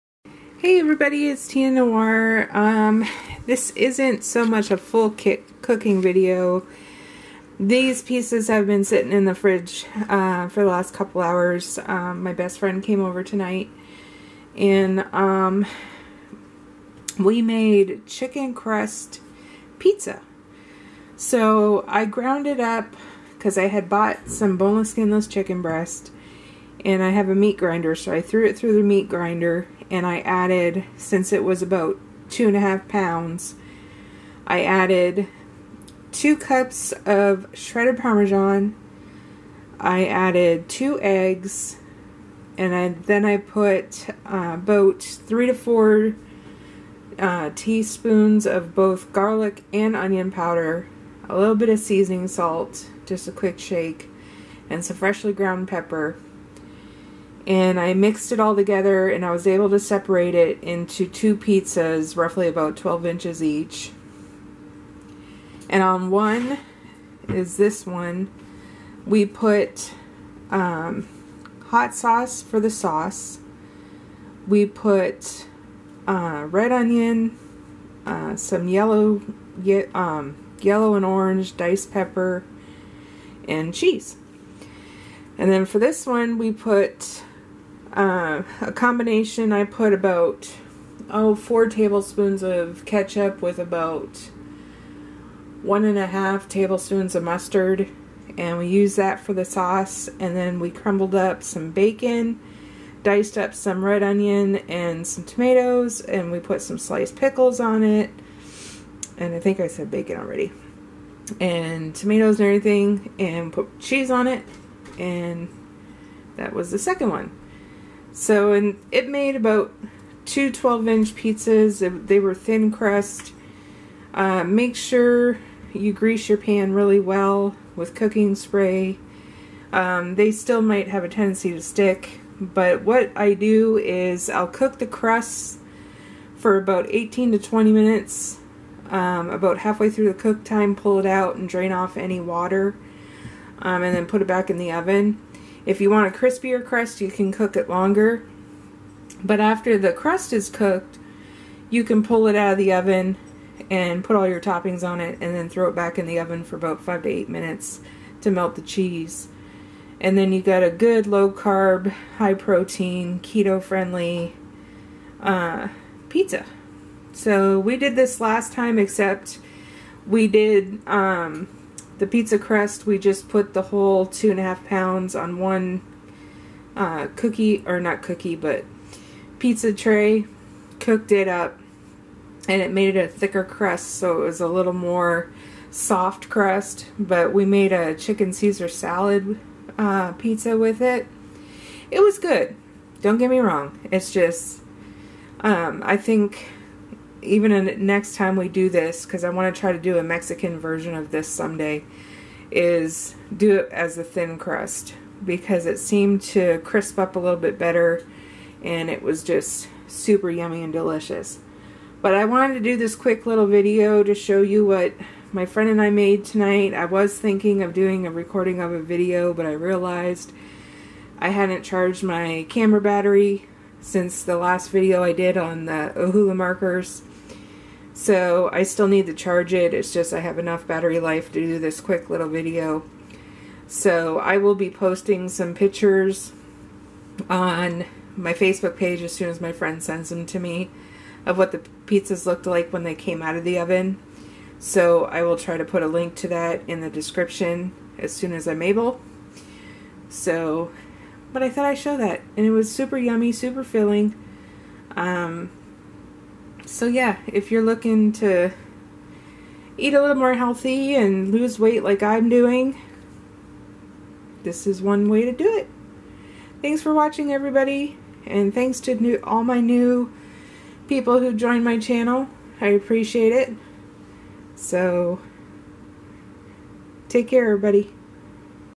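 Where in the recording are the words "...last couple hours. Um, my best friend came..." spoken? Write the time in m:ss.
0:10.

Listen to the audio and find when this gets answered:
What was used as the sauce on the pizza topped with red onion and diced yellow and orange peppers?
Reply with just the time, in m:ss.
1:11.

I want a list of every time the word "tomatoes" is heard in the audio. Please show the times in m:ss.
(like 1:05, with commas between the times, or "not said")
1:45, 1:51.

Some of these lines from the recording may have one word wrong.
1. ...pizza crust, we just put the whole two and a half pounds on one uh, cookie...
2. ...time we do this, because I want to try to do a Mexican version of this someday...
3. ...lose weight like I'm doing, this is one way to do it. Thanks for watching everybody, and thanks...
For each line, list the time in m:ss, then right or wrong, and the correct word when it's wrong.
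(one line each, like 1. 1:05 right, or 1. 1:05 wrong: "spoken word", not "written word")
1. 2:52 right
2. 3:18 right
3. 4:21 right.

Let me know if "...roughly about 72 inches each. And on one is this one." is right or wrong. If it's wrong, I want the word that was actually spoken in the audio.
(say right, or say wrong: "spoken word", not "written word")
wrong: "12", not "72".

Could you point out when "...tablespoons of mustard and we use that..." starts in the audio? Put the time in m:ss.
1:36.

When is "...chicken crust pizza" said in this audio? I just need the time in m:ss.
0:18.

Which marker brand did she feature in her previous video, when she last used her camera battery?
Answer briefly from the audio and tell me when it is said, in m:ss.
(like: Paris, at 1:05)
Ohuhu, at 3:45.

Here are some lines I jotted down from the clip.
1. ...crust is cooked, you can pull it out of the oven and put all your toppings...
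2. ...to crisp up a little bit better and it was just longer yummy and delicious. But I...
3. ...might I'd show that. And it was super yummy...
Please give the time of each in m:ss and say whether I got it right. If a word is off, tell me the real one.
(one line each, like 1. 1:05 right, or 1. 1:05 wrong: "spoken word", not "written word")
1. 2:29 right
2. 3:26 wrong: "super", not "longer"
3. 4:11 wrong: "thought", not "might".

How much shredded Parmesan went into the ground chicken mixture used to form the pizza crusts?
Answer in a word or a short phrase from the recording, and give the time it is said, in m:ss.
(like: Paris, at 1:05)
2 cups, at 0:36.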